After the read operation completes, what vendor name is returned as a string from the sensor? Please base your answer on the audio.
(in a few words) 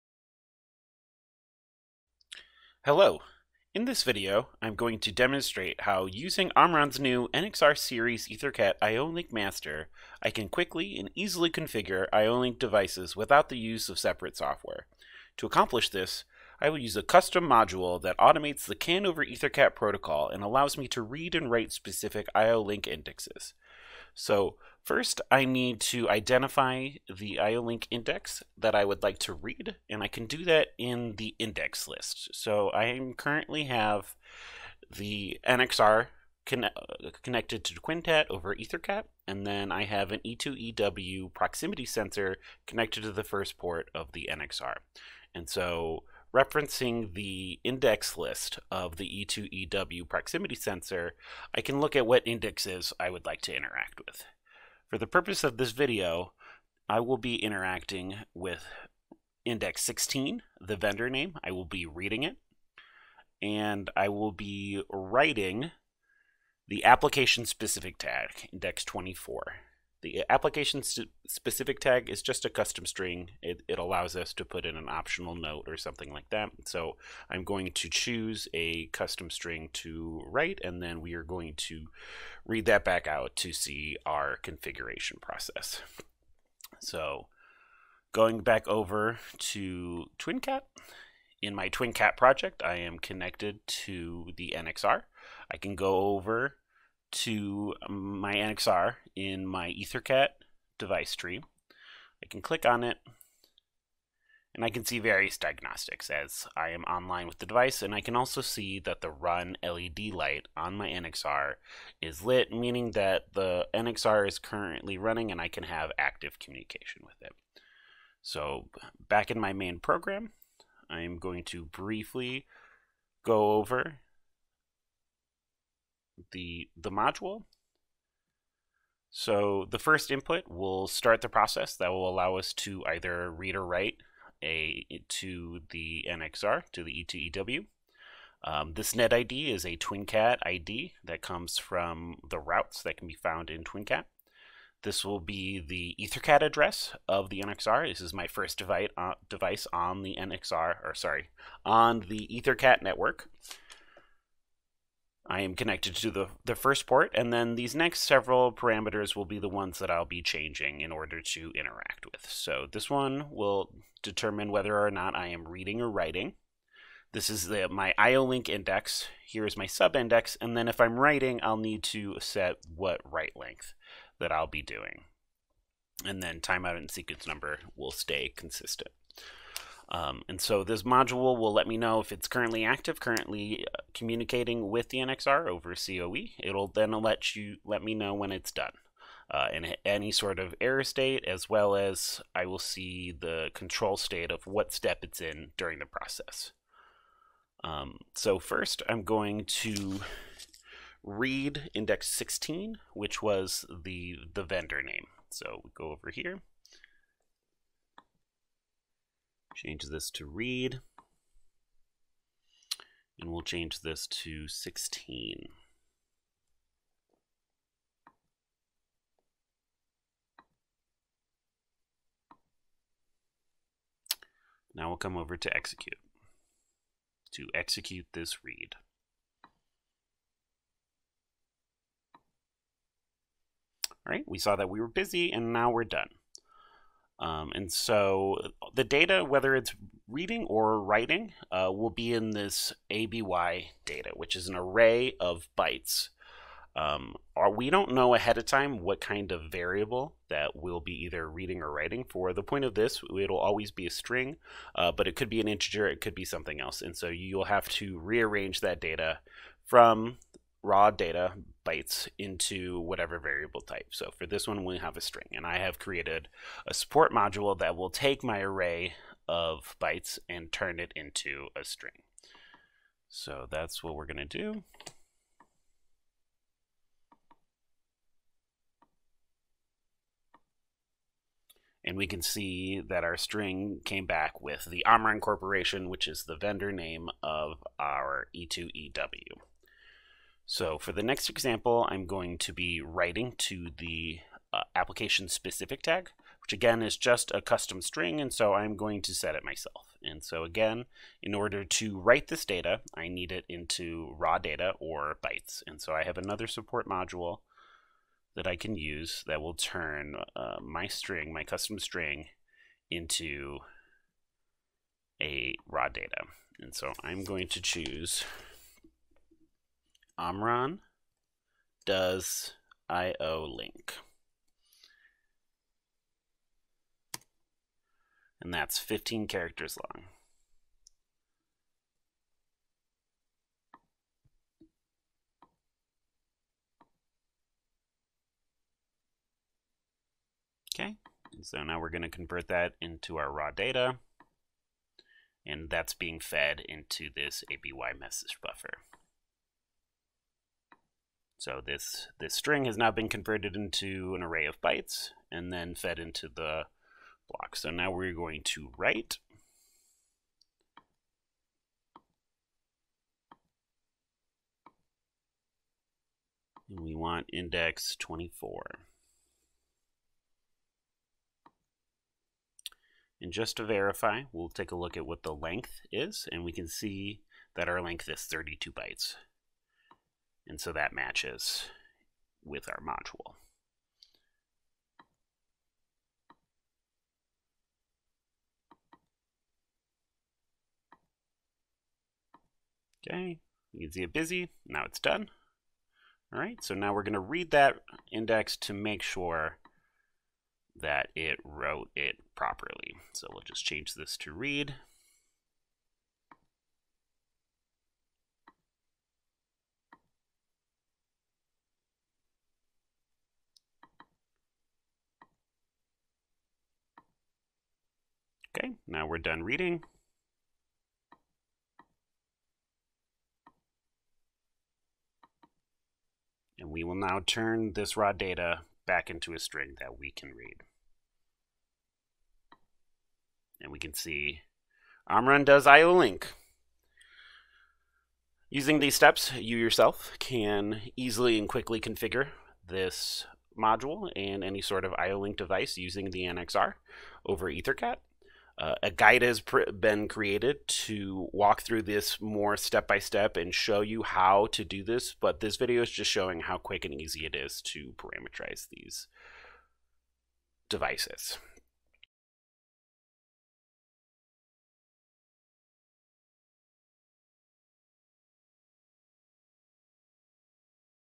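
Omron Corporation.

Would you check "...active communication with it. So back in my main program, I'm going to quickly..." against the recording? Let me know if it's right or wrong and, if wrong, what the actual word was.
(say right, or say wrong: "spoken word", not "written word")
wrong: "briefly", not "quickly".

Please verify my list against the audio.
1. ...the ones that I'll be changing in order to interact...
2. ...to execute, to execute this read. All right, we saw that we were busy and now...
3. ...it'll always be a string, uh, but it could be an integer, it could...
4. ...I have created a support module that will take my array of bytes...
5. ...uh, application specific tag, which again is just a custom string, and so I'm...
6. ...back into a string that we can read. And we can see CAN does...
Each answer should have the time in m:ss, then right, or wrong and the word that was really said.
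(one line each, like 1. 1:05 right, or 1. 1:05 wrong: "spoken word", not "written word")
1. 2:39 right
2. 3:45 right
3. 4:13 right
4. 4:25 right
5. 4:54 right
6. 7:08 wrong: "Omron", not "CAN".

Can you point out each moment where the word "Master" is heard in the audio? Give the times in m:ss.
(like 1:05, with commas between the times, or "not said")
0:09.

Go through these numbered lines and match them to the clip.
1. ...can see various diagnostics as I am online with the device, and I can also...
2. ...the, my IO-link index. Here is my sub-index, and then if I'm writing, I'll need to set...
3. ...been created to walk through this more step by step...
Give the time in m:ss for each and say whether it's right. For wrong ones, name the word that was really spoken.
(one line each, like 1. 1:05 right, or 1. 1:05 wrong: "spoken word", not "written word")
1. 1:44 right
2. 2:47 right
3. 7:29 right.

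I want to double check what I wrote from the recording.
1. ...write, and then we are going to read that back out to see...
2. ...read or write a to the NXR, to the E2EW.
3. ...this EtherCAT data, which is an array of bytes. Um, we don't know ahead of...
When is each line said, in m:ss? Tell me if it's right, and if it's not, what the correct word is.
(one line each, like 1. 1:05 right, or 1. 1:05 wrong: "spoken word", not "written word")
1. 1:20 right
2. 2:13 right
3. 4:02 wrong: "ABY", not "EtherCAT".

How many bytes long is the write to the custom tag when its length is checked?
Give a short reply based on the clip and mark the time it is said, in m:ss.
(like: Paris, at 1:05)
32, at 6:18.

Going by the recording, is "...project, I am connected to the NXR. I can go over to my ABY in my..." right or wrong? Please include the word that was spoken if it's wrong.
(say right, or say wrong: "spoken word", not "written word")
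wrong: "NXR", not "ABY".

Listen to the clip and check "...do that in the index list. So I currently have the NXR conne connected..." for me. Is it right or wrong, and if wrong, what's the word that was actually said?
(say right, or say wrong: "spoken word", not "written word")
right.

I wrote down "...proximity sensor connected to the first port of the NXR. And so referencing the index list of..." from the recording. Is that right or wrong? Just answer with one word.
right.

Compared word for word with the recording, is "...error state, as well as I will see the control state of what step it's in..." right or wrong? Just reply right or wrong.
right.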